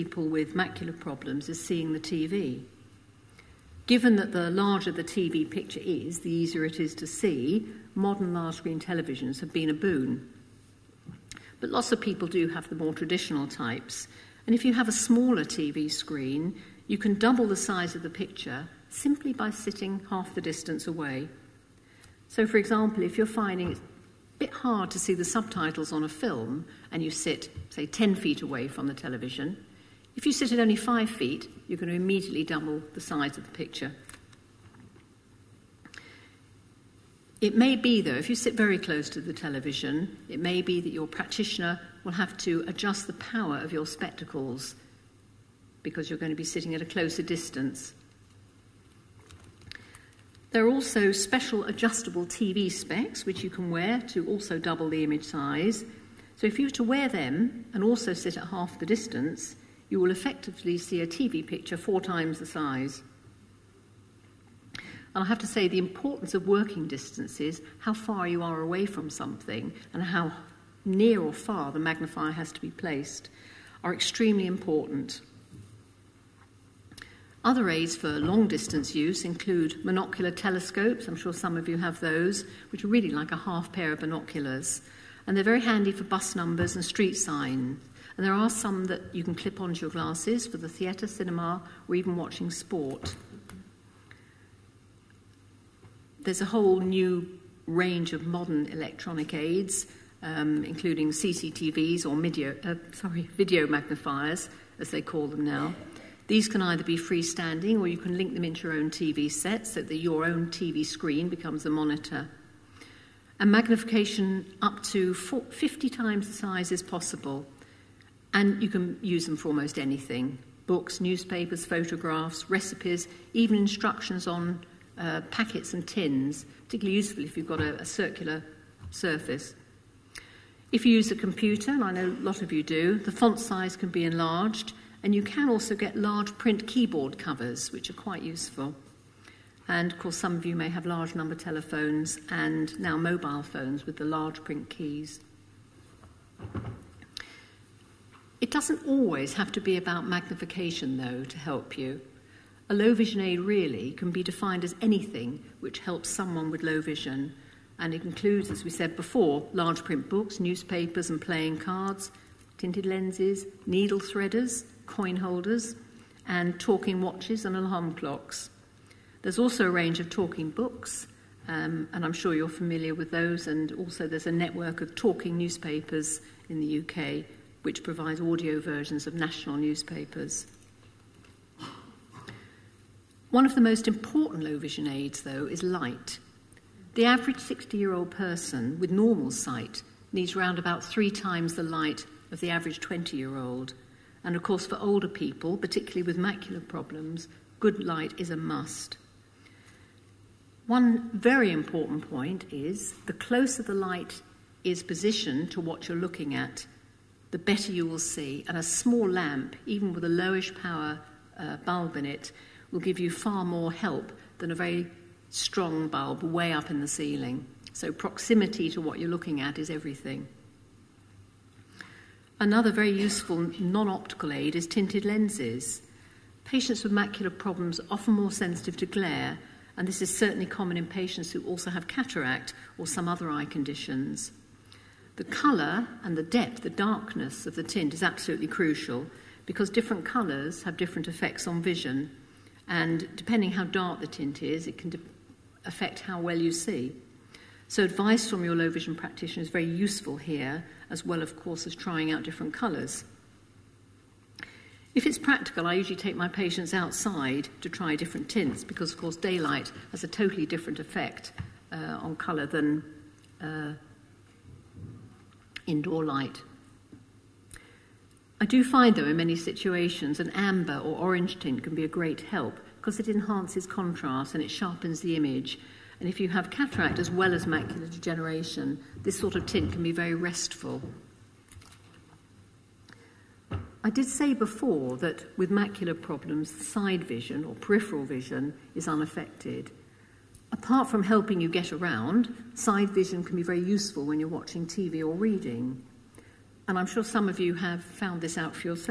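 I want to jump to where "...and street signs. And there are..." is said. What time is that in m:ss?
1:26.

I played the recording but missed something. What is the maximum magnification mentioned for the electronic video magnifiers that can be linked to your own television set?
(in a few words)
50 times.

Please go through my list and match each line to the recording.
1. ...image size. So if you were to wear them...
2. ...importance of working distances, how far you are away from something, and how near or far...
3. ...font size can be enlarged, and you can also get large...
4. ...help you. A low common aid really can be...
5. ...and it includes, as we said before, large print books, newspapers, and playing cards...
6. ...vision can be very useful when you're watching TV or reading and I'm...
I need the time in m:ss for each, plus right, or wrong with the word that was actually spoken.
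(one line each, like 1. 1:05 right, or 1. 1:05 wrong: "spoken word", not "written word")
1. 0:55 right
2. 1:05 right
3. 2:13 right
4. 2:31 wrong: "vision", not "common"
5. 2:37 right
6. 4:52 right.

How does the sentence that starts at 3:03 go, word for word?
One of the most important low vision aids, though, is light.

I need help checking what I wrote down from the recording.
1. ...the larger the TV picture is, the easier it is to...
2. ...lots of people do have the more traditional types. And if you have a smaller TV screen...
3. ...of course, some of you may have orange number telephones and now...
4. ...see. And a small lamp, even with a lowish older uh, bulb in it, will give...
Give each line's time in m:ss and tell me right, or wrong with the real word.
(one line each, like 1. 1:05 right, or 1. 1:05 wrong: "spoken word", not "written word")
1. 0:04 right
2. 0:11 right
3. 2:19 wrong: "large", not "orange"
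4. 3:27 wrong: "power", not "older".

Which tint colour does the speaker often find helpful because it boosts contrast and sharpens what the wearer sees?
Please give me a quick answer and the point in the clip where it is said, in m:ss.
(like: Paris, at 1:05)
amber or orange, at 4:30.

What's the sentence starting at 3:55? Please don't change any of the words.
The colour and the depth, the darkness of the tint is absolutely crucial because different colours have different effects on vision.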